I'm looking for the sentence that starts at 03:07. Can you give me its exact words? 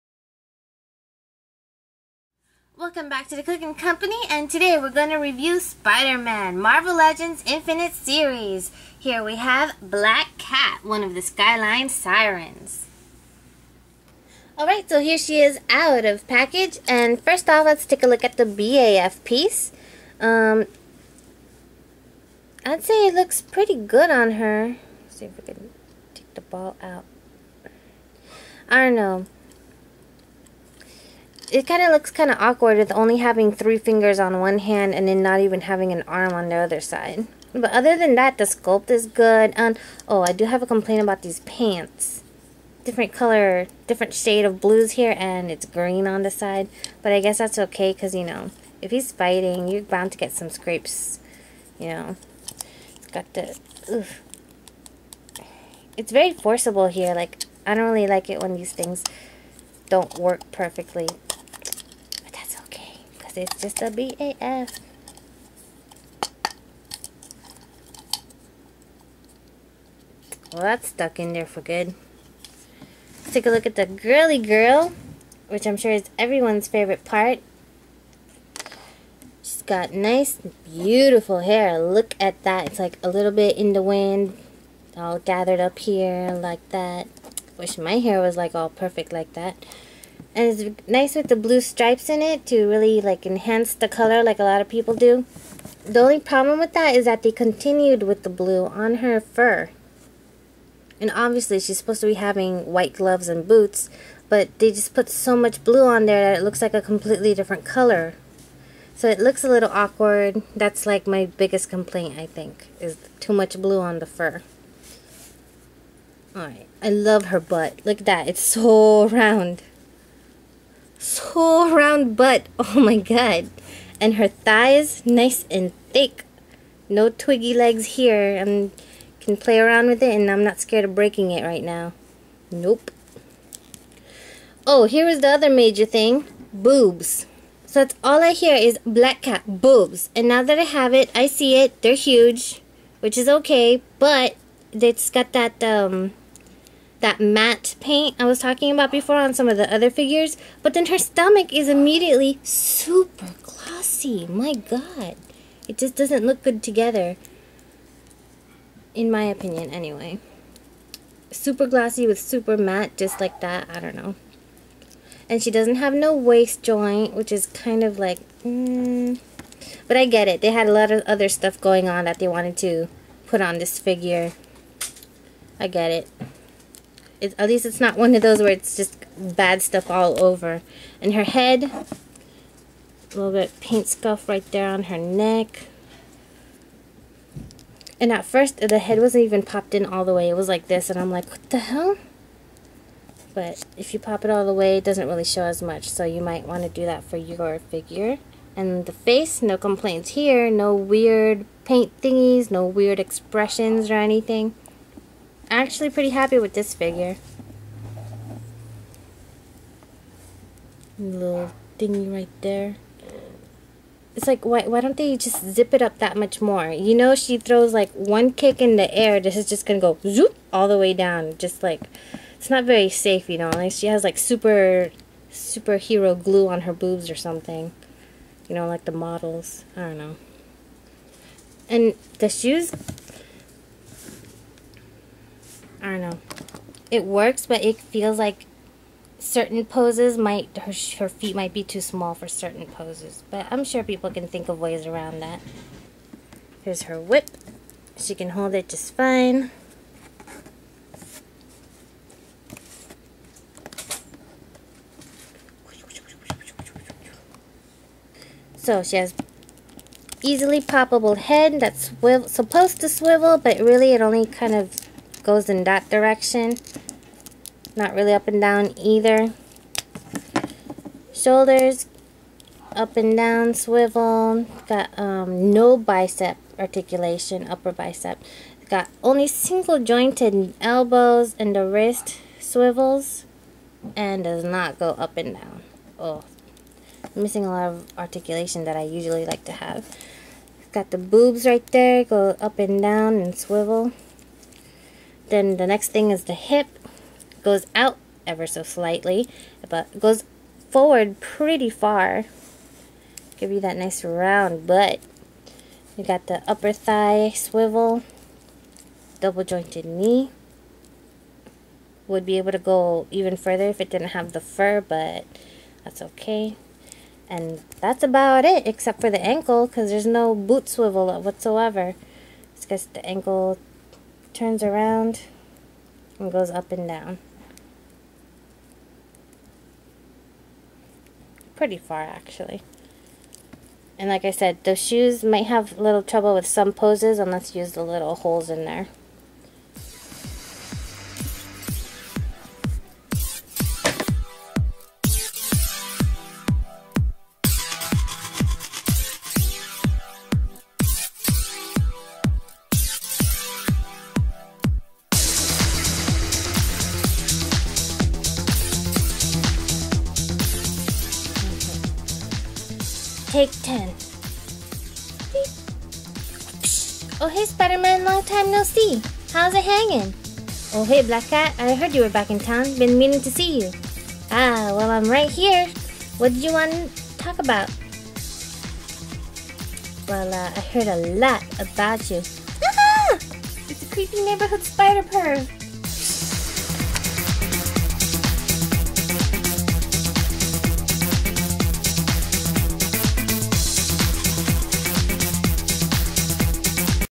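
And at first, the head wasn't even popped in all the way.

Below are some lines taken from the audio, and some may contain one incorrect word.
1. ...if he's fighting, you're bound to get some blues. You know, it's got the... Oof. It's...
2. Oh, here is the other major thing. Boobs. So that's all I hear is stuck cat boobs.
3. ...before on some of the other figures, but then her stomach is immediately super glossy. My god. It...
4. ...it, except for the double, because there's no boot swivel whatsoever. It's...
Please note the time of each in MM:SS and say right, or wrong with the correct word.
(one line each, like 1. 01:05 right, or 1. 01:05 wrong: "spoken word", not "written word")
1. 00:48 wrong: "scrapes", not "blues"
2. 02:14 wrong: "black", not "stuck"
3. 02:28 right
4. 05:18 wrong: "ankle", not "double".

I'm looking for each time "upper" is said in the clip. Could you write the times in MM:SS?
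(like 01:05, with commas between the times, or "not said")
04:37, 05:06.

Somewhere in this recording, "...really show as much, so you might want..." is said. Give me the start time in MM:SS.
03:15.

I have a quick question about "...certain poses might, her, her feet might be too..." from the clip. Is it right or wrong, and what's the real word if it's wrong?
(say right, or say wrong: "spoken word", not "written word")
right.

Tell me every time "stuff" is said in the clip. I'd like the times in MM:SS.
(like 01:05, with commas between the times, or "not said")
02:51, 02:59.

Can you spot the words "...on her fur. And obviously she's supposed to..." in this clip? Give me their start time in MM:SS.
01:38.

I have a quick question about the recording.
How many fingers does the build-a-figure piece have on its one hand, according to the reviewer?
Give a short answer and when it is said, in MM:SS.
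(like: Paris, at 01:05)
3, at 00:33.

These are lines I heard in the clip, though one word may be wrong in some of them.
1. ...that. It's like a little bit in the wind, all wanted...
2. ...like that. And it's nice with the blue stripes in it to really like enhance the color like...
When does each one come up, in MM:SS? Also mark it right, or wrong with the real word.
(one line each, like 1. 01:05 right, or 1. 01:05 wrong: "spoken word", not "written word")
1. 01:22 wrong: "gathered", not "wanted"
2. 01:29 right.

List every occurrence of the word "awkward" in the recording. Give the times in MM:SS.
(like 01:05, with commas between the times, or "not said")
00:32, 01:49.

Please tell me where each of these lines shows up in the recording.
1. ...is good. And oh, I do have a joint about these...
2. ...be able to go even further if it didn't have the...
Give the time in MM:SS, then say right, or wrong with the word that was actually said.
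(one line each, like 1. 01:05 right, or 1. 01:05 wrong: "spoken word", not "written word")
1. 00:38 wrong: "complaint", not "joint"
2. 05:12 right.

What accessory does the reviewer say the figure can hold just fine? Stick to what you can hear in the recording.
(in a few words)
Whip.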